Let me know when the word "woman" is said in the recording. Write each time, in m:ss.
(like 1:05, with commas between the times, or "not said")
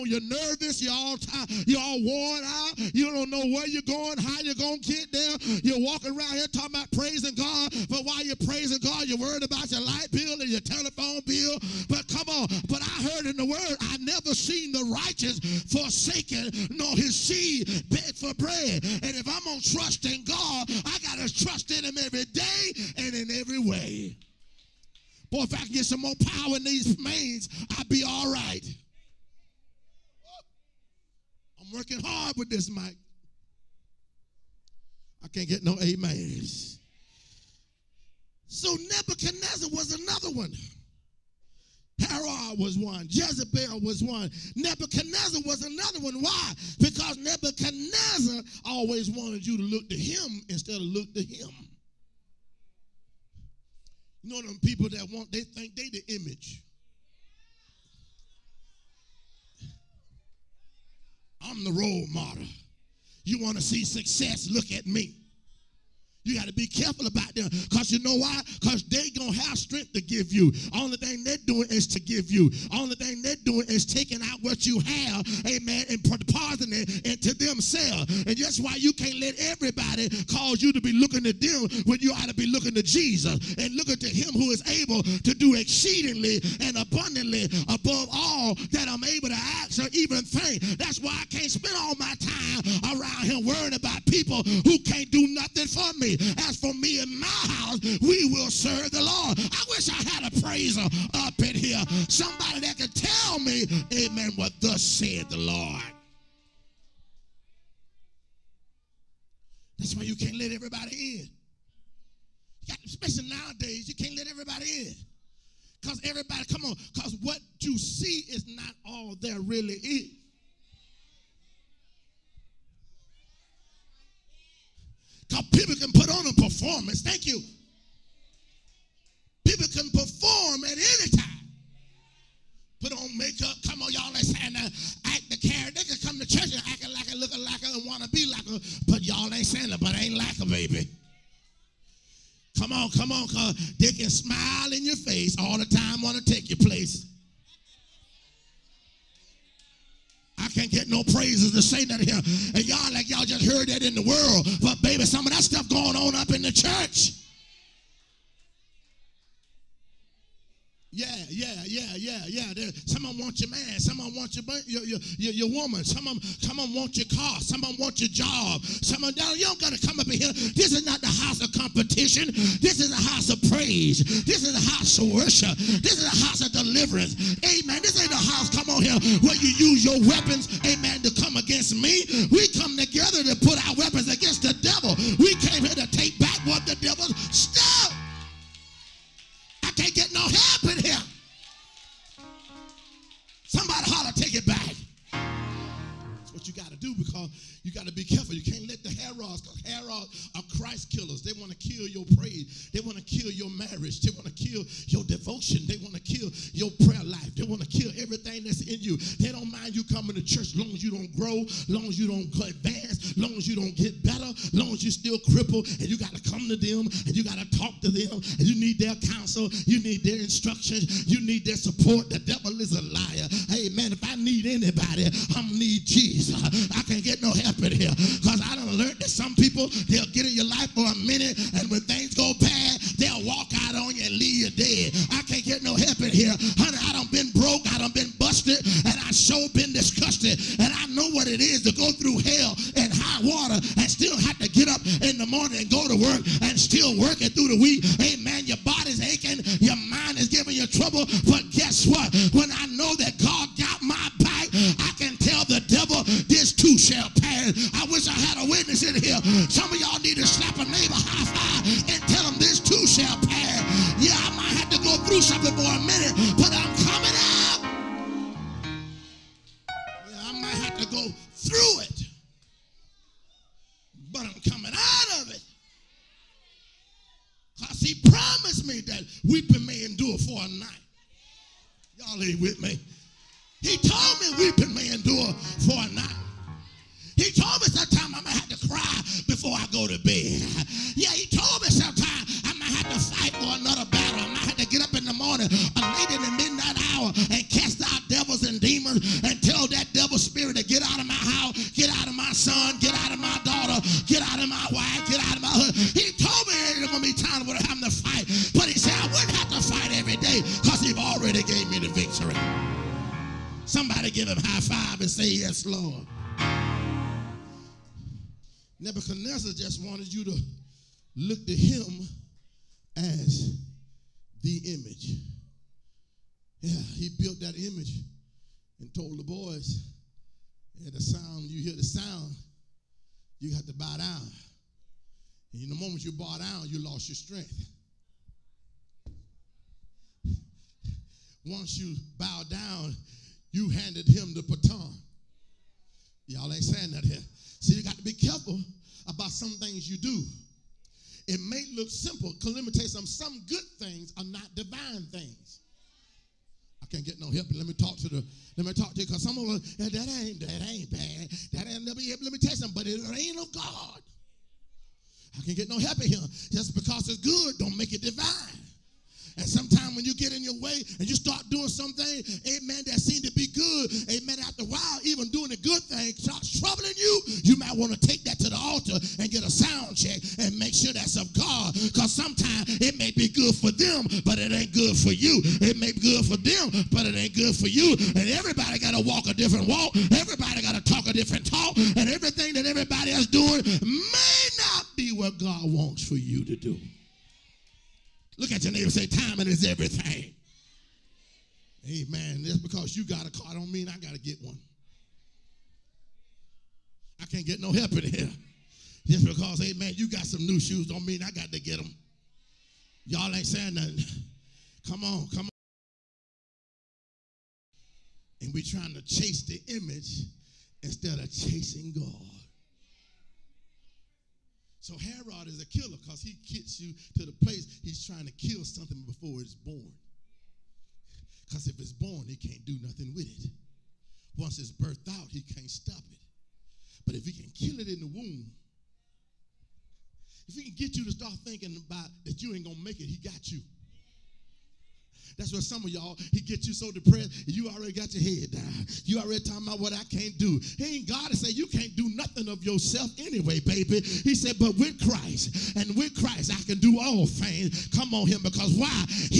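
2:45.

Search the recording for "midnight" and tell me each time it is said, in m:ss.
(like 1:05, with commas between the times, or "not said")
4:56.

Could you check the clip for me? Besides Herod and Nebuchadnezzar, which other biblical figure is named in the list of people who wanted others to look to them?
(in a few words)
Jezebel.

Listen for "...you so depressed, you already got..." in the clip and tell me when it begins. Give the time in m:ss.
7:26.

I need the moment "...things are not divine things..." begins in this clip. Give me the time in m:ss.
5:53.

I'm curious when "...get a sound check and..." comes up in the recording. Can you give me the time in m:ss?
6:19.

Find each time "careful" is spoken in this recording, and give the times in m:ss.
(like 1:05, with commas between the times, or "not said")
1:06, 3:18, 5:48.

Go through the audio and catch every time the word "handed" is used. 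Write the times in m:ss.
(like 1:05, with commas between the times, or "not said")
5:43.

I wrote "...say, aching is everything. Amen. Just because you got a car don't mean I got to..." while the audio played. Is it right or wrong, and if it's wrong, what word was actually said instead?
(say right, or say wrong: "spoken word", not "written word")
wrong: "timing", not "aching".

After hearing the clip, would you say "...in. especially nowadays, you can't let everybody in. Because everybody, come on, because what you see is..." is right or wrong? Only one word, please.
right.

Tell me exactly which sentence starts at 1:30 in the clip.
That's why I can't spend all my time around him worrying about people who can't do nothing for me.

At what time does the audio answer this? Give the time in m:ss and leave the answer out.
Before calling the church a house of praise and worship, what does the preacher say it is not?
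2:51.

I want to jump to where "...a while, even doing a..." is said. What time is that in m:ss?
6:14.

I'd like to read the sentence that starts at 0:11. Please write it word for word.
But come on, but I heard in the word, I never seen the righteous forsake naked nor his seed beg for bread.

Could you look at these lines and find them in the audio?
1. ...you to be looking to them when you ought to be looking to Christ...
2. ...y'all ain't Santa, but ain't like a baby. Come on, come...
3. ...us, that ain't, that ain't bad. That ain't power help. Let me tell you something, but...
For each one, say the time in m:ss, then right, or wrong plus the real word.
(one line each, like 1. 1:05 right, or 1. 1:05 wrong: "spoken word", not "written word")
1. 1:20 wrong: "Jesus", not "Christ"
2. 2:19 right
3. 5:59 wrong: "never", not "power".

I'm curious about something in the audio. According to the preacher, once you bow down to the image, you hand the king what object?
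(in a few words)
The baton.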